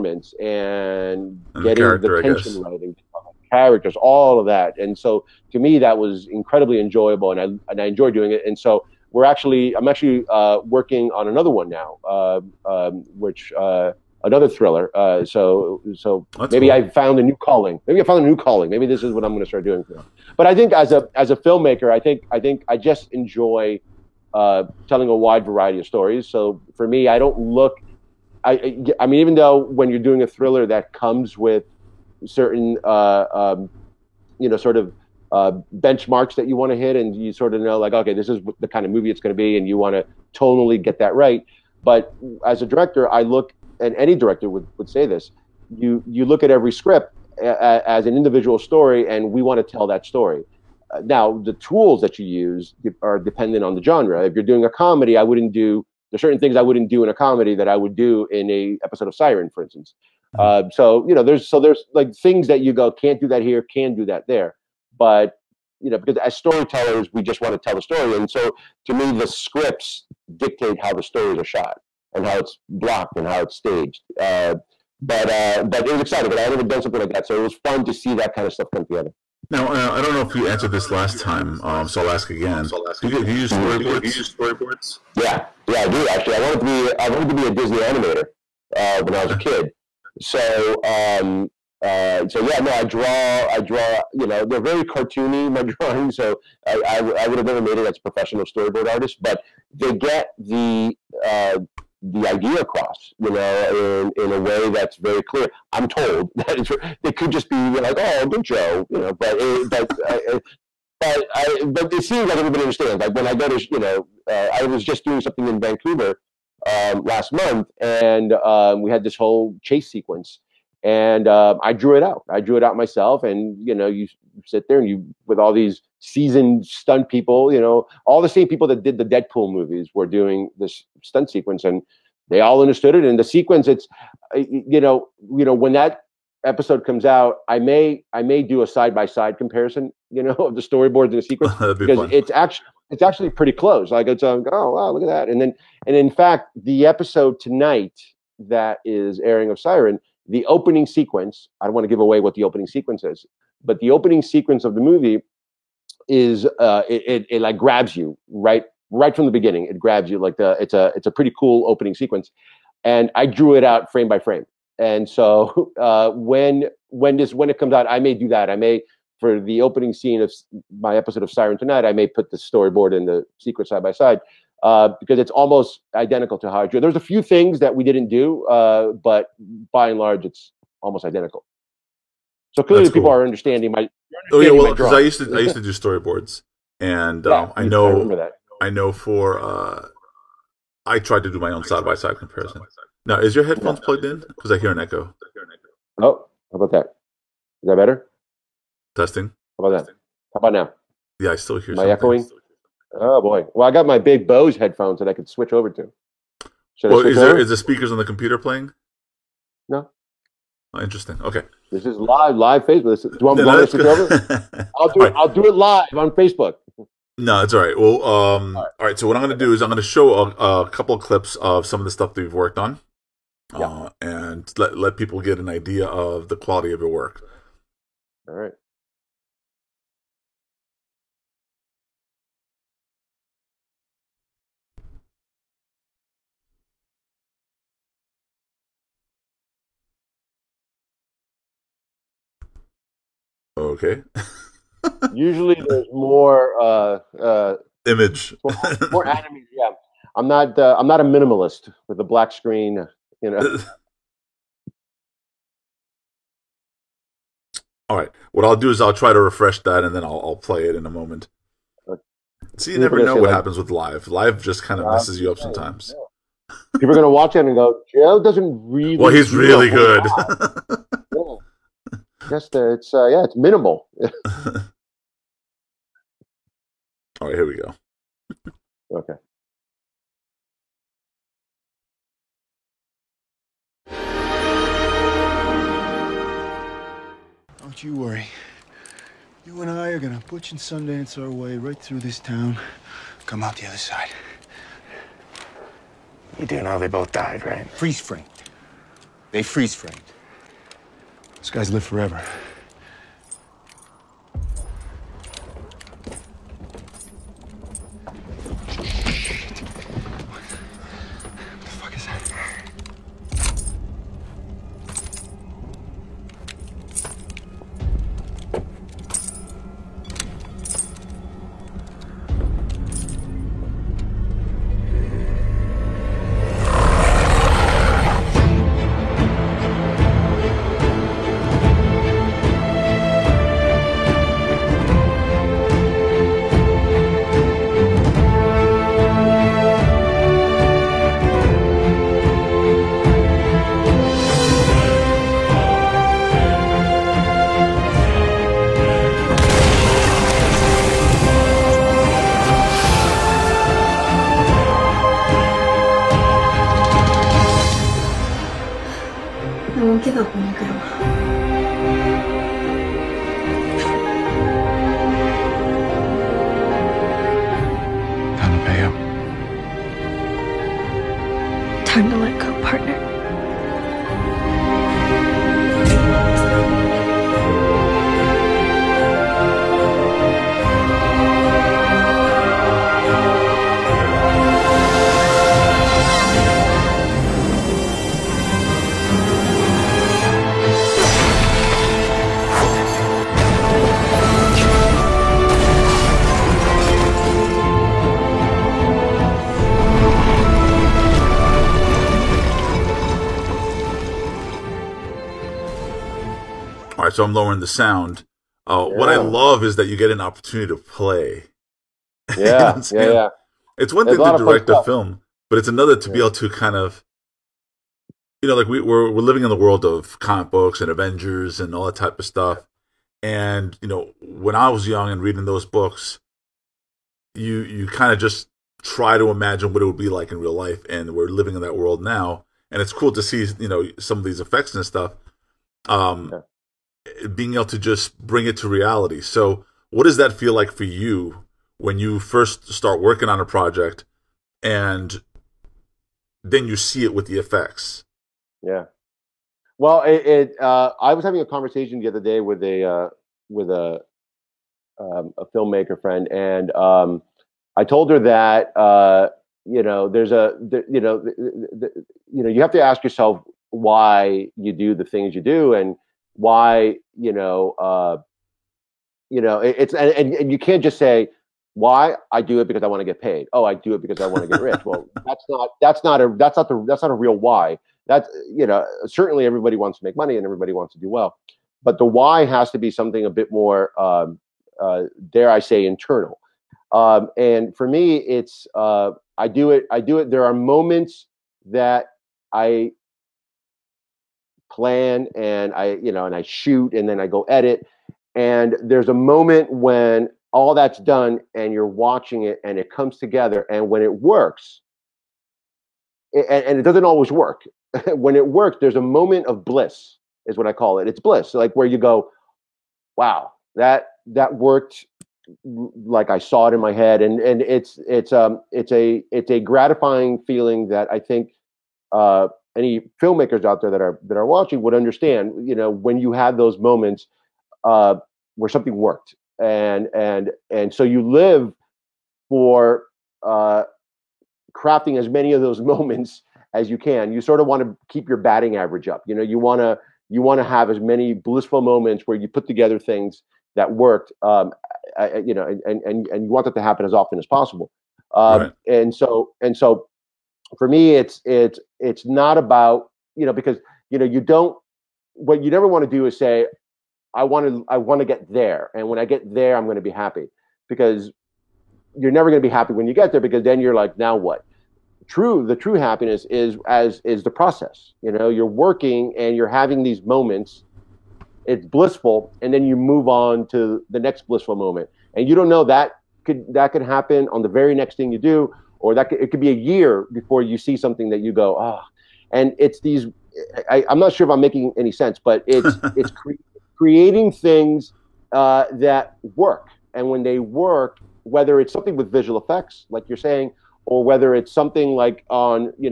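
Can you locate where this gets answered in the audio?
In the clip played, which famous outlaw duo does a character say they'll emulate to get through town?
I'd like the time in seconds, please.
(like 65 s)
290 s.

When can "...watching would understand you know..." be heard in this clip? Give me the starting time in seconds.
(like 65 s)
524 s.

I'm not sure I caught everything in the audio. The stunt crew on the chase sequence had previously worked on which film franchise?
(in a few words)
Deadpool.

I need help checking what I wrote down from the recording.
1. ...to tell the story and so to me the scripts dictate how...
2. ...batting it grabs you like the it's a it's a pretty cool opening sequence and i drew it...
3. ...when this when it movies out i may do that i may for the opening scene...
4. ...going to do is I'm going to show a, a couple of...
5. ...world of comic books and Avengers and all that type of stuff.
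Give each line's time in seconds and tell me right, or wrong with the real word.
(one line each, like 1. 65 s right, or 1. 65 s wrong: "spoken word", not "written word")
1. 67 s right
2. 159 s wrong: "beginning", not "batting"
3. 166 s wrong: "comes", not "movies"
4. 219 s right
5. 419 s right.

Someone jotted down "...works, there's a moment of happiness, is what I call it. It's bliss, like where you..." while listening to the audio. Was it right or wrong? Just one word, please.
wrong.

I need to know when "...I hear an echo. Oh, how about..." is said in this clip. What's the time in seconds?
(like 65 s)
194 s.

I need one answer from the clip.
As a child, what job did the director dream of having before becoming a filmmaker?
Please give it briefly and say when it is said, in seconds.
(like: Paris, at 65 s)
Disney animator, at 87 s.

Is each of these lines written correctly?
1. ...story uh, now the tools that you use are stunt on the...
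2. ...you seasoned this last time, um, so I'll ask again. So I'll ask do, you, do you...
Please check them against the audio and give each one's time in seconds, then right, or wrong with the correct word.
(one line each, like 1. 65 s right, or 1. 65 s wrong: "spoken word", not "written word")
1. 50 s wrong: "dependent", not "stunt"
2. 80 s wrong: "answered", not "seasoned".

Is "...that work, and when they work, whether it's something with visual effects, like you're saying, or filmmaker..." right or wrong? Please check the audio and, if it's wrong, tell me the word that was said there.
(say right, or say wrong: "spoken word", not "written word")
wrong: "whether", not "filmmaker".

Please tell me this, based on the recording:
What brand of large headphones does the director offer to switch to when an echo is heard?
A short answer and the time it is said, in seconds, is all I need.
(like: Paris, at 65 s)
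Bose, at 204 s.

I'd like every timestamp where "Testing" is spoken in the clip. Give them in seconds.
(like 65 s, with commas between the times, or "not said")
198 s.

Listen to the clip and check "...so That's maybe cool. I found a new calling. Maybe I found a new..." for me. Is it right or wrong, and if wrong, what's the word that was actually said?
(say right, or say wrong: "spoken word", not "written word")
right.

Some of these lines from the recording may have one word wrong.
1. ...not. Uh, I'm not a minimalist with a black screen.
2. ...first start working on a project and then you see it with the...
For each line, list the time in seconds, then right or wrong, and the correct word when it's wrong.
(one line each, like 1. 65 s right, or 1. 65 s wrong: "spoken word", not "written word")
1. 250 s right
2. 442 s right.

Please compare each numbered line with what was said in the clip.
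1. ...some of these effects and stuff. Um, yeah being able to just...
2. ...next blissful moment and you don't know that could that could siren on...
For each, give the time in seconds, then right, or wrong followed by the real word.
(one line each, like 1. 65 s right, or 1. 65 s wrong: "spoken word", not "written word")
1. 433 s right
2. 574 s wrong: "happen", not "siren".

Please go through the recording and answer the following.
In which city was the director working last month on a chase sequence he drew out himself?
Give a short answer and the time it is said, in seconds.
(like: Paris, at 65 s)
Vancouver, at 115 s.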